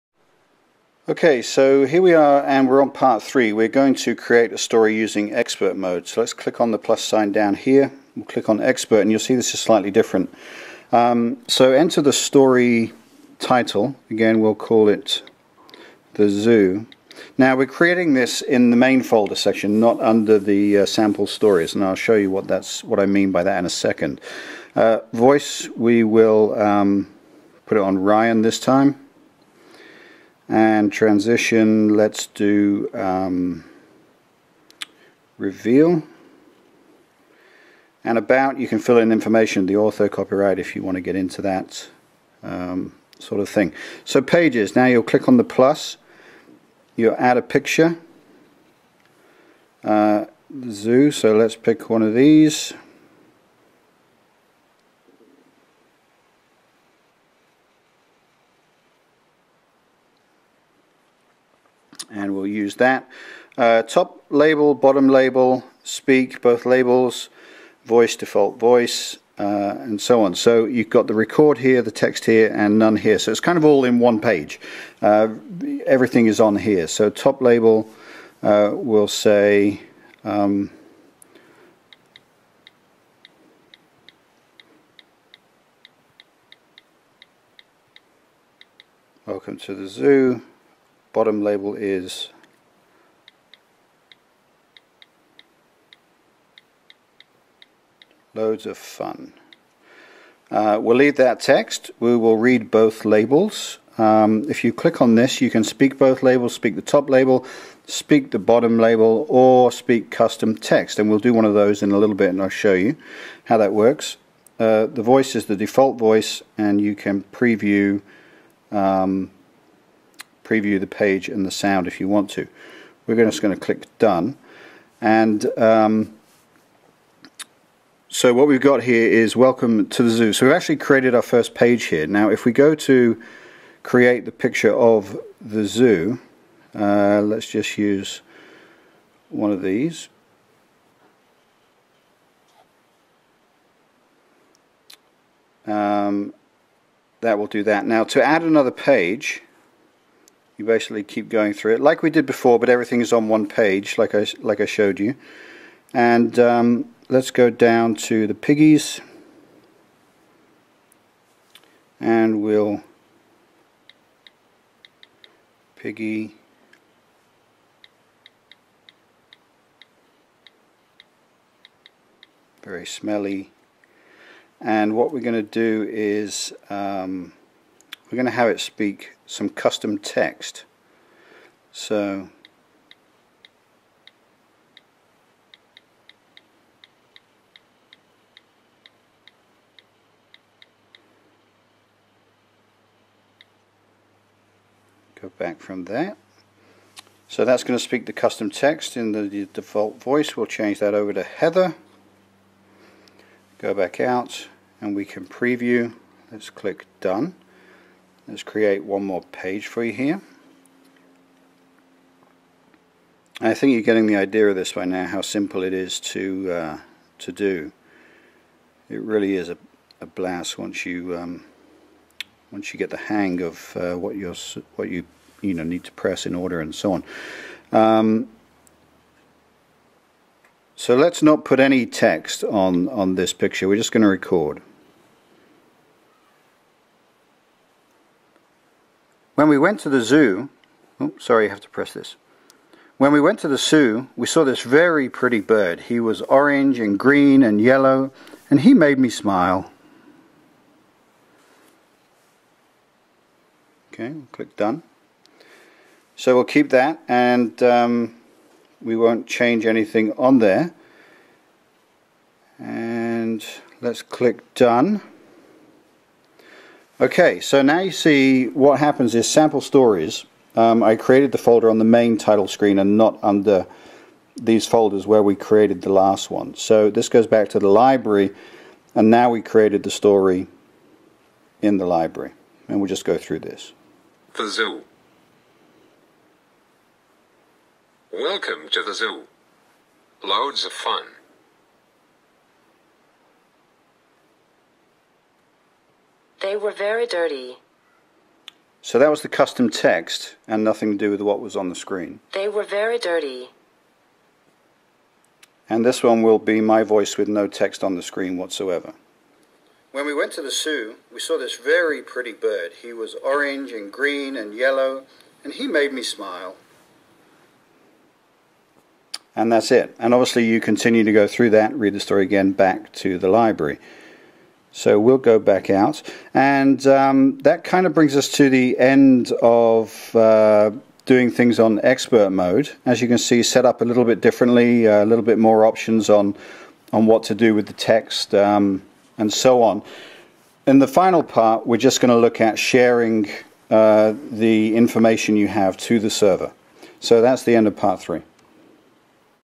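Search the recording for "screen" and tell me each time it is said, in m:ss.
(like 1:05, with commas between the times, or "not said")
4:32, 5:01, 5:08.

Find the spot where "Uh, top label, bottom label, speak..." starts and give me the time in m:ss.
1:03.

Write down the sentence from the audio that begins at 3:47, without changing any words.
Um, so let's not put any text on on this picture.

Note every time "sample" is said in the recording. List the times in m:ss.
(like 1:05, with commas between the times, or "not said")
0:20, 4:29.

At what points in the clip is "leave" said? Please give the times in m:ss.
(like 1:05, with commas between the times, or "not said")
1:40.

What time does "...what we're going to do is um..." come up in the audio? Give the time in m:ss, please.
2:54.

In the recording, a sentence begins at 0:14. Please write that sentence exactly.
Again, we'll call it the zoo.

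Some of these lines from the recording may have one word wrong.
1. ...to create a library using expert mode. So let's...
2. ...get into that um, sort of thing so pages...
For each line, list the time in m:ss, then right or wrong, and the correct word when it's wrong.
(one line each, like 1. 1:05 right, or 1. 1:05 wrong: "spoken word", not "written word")
1. 0:03 wrong: "story", not "library"
2. 0:41 right.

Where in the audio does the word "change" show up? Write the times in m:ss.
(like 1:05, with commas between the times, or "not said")
3:20, 4:19.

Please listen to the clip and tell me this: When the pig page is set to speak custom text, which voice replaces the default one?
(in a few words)
Heather.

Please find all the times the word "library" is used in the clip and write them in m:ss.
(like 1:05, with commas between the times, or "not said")
4:37, 4:41, 5:23.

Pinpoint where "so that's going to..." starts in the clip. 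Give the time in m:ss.
3:17.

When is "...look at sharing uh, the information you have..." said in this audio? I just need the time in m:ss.
5:42.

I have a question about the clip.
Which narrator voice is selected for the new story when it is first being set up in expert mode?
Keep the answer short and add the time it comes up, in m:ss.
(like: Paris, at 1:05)
Ryan, at 0:27.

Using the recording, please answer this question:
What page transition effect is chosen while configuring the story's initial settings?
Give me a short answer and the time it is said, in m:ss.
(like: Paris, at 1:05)
Reveal, at 0:35.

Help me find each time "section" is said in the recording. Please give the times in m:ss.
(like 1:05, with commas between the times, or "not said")
0:19.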